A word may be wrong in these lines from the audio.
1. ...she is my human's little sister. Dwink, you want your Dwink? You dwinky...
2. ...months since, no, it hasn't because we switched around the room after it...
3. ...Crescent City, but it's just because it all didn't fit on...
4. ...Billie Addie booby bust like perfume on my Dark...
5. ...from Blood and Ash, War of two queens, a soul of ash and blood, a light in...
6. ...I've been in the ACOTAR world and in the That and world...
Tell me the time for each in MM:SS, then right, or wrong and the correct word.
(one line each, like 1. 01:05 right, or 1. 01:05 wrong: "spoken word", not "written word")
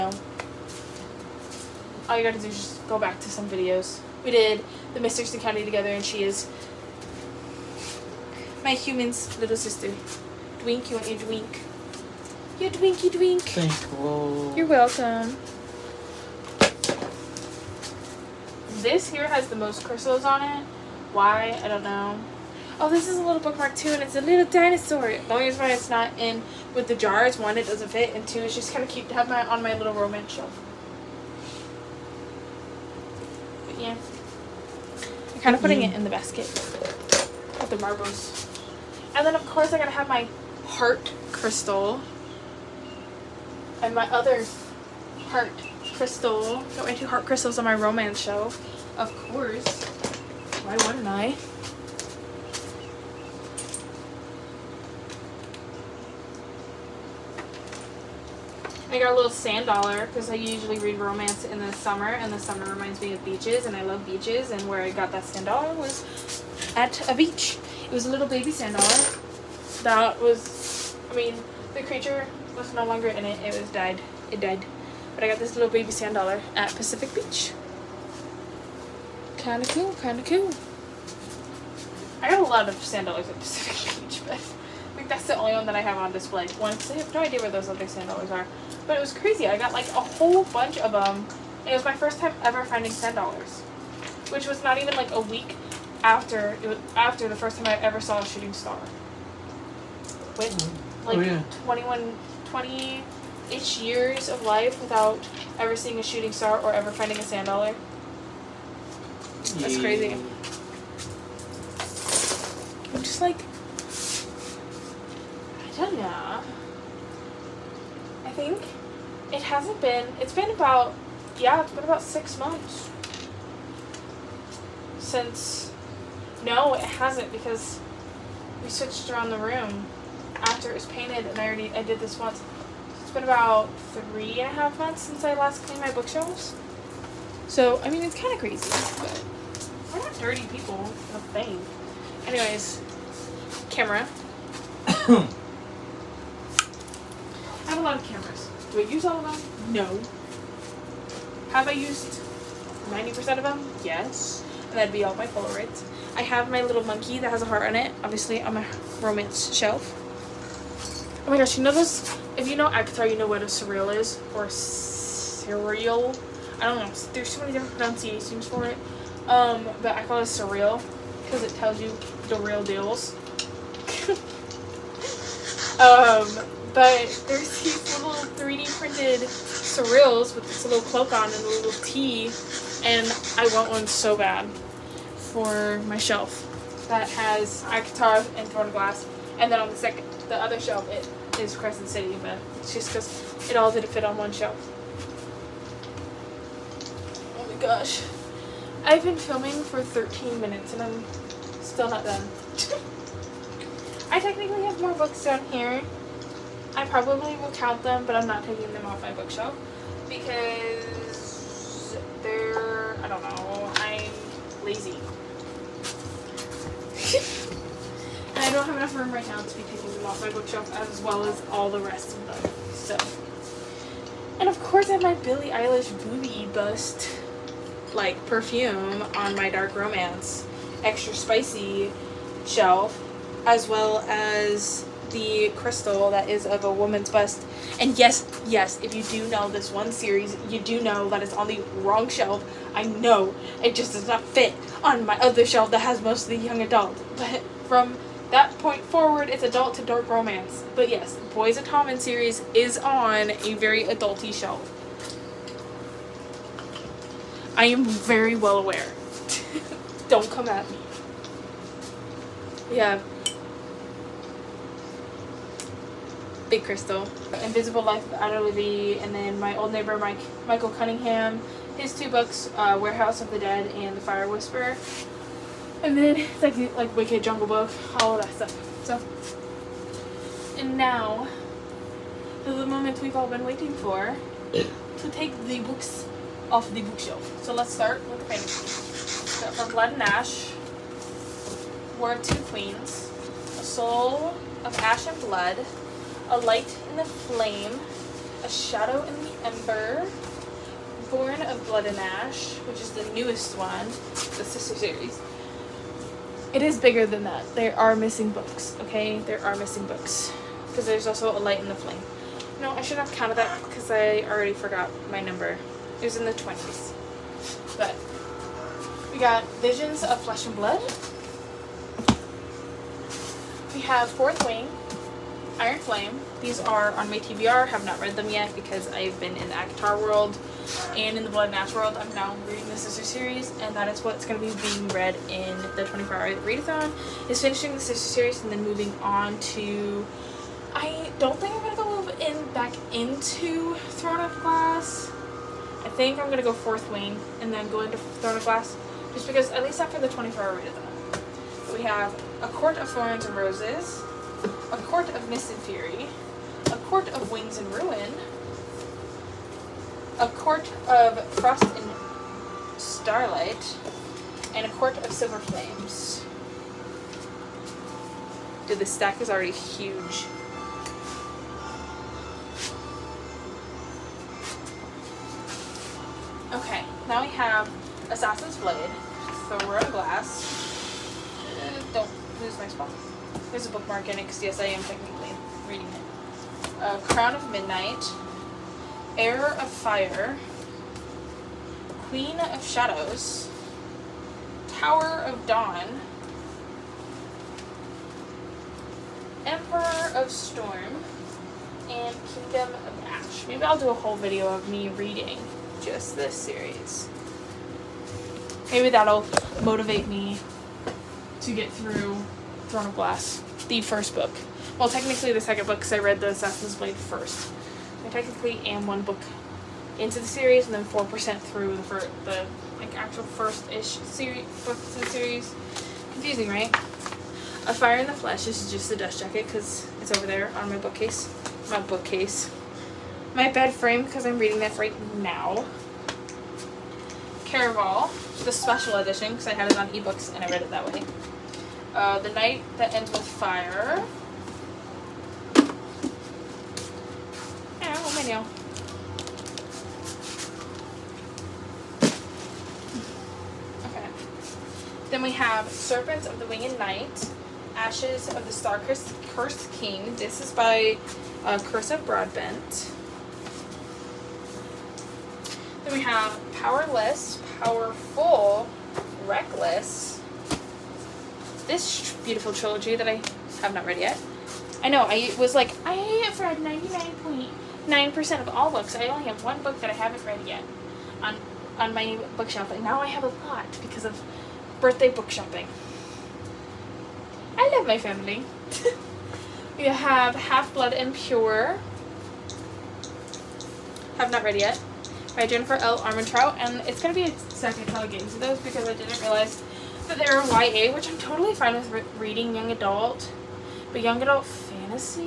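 1. 00:06 right
2. 02:02 right
3. 03:11 right
4. 03:45 wrong: "Eilish", not "Addie"
5. 04:49 right
6. 05:28 wrong: "Blood", not "That".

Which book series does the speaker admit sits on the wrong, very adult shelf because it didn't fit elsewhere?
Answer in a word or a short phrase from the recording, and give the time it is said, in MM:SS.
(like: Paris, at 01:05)
Boys of Tommen, at 04:11.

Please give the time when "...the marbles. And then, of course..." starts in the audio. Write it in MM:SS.
00:37.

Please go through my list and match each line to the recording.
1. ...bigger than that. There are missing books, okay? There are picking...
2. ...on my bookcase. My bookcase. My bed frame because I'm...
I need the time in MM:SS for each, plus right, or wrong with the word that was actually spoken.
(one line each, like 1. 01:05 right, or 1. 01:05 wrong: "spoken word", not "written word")
1. 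05:06 wrong: "missing", not "picking"
2. 07:10 right.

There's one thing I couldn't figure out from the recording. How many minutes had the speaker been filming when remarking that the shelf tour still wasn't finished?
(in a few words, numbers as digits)
13.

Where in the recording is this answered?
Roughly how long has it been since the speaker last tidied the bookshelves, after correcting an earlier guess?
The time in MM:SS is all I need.
02:13.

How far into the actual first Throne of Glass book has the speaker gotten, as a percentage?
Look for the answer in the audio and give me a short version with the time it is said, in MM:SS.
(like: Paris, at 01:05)
4%, at 07:00.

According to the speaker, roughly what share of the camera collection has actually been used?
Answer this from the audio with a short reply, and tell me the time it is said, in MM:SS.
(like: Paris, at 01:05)
90%, at 02:32.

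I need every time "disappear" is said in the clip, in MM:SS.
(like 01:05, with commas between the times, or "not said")
not said.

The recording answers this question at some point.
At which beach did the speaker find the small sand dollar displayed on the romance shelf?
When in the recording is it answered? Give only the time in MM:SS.
01:16.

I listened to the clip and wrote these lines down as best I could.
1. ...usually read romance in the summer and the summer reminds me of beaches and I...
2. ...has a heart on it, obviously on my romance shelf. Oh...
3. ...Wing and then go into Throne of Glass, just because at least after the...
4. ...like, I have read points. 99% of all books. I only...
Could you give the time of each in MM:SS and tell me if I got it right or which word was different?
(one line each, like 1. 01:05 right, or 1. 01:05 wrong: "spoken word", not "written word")
1. 01:00 right
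2. 02:37 right
3. 05:46 right
4. 07:55 right.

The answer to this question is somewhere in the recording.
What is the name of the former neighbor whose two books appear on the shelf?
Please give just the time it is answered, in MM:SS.
04:30.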